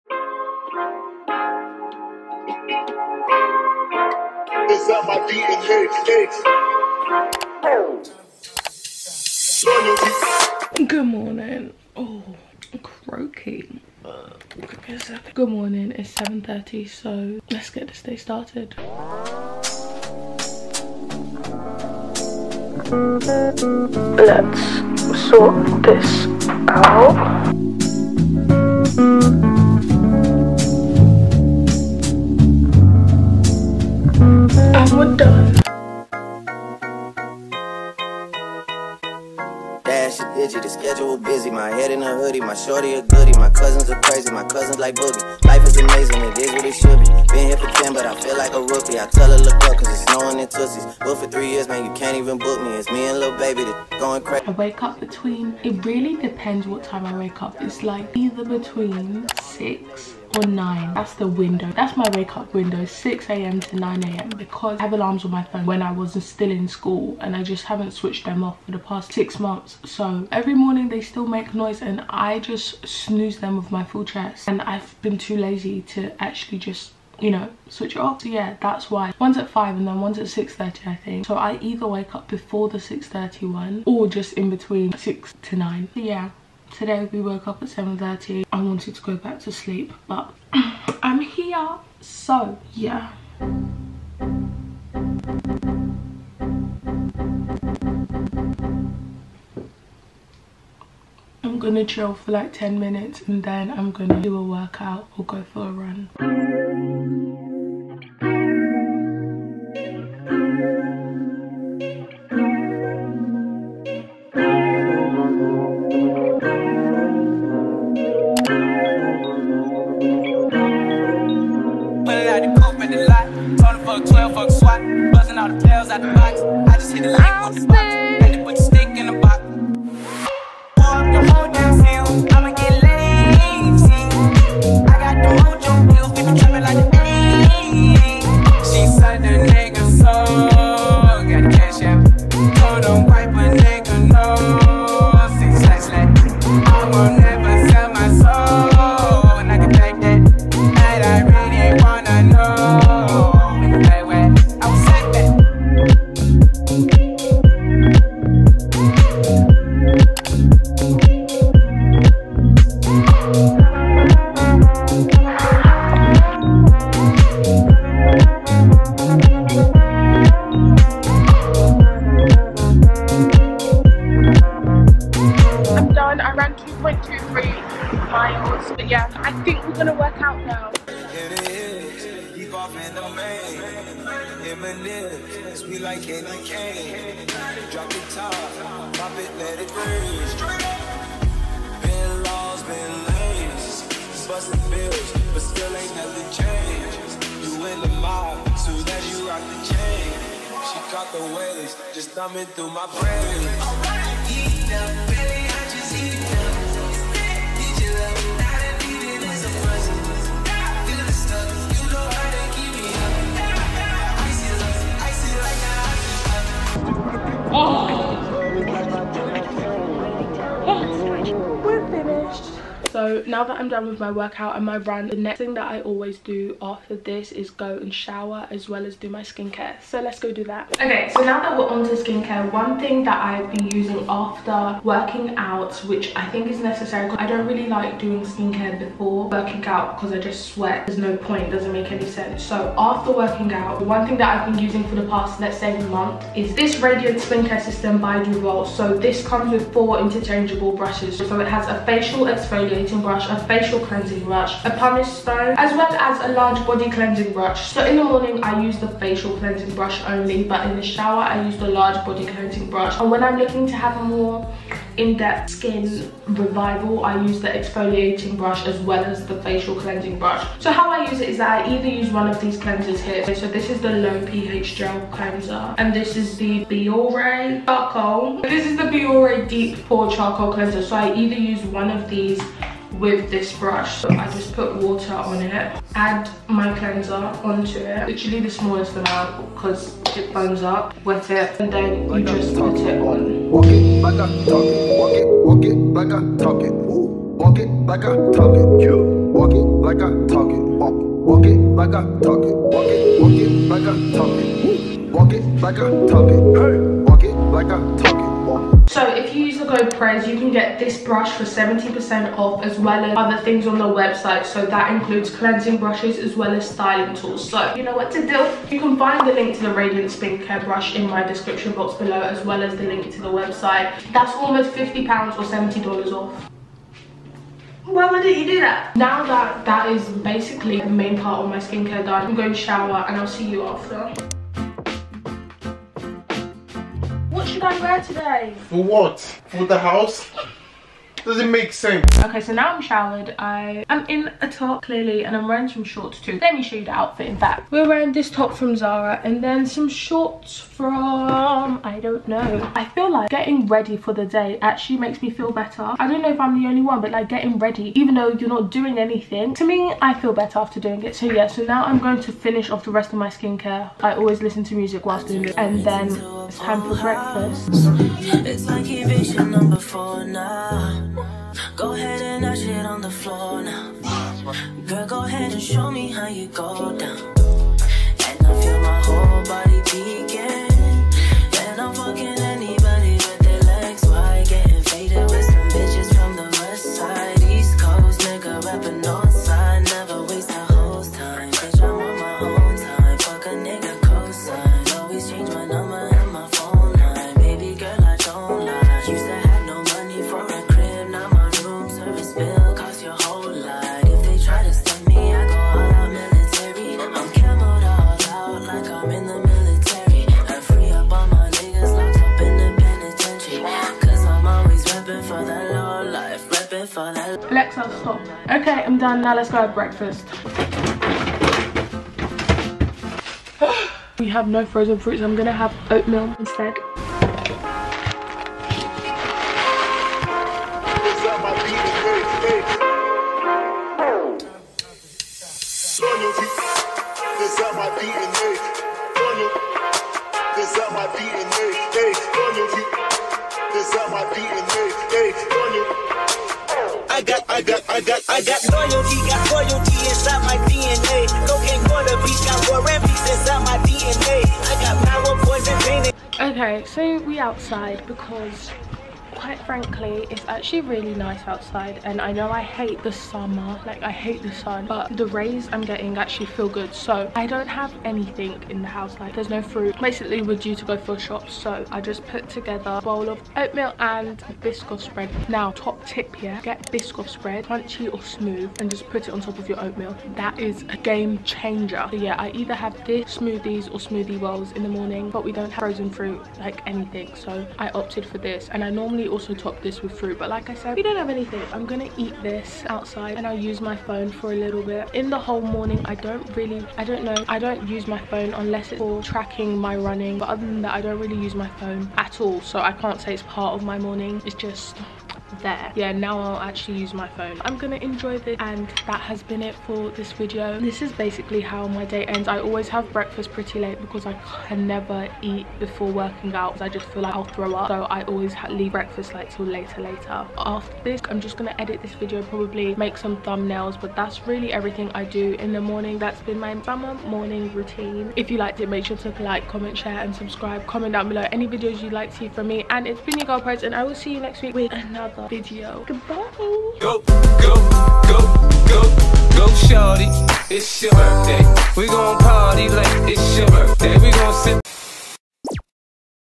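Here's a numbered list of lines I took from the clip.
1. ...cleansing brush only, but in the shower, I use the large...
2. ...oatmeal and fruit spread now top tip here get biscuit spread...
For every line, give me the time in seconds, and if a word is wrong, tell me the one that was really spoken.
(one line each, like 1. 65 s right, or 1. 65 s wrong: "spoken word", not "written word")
1. 259 s right
2. 473 s wrong: "biscuit", not "fruit".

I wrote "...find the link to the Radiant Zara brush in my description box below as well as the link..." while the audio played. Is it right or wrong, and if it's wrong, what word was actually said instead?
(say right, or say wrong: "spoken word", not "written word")
wrong: "Care", not "Zara".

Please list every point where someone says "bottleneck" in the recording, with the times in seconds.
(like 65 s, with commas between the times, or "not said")
not said.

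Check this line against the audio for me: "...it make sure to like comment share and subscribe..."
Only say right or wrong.
right.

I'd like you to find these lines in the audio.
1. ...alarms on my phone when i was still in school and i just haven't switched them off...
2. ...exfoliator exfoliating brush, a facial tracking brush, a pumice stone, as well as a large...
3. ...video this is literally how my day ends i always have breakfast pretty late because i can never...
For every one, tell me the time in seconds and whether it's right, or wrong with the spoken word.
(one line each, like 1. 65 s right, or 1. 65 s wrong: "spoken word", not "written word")
1. 64 s right
2. 252 s wrong: "cleansing", not "tracking"
3. 510 s wrong: "basically", not "literally".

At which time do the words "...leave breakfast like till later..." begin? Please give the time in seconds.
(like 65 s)
518 s.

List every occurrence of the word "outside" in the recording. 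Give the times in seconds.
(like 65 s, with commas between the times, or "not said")
457 s, 461 s, 492 s.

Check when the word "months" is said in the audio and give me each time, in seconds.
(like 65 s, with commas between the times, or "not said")
69 s, 245 s.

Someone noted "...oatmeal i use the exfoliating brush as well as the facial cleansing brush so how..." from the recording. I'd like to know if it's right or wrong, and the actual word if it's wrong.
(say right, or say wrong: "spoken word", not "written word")
wrong: "revival", not "oatmeal".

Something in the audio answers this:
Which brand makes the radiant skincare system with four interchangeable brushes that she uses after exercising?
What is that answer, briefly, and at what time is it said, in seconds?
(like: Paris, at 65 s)
Duvolle, at 248 s.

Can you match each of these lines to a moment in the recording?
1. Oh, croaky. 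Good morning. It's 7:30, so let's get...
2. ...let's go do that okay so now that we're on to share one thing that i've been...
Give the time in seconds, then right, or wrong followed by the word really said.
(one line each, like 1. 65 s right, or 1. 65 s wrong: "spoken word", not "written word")
1. 11 s right
2. 230 s wrong: "skincare", not "share".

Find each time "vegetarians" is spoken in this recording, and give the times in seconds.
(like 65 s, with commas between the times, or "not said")
not said.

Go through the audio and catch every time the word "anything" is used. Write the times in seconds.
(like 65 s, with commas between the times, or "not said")
358 s, 468 s, 486 s, 491 s.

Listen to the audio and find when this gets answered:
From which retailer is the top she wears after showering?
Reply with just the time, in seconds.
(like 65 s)
348 s.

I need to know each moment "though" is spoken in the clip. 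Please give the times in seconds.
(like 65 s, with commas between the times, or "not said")
358 s.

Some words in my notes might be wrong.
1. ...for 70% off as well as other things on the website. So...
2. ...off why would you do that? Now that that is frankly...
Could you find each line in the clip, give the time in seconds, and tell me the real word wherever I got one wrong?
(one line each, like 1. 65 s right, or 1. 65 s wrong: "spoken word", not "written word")
1. 311 s right
2. 326 s wrong: "basically", not "frankly".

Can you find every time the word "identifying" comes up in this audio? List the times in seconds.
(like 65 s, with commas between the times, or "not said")
not said.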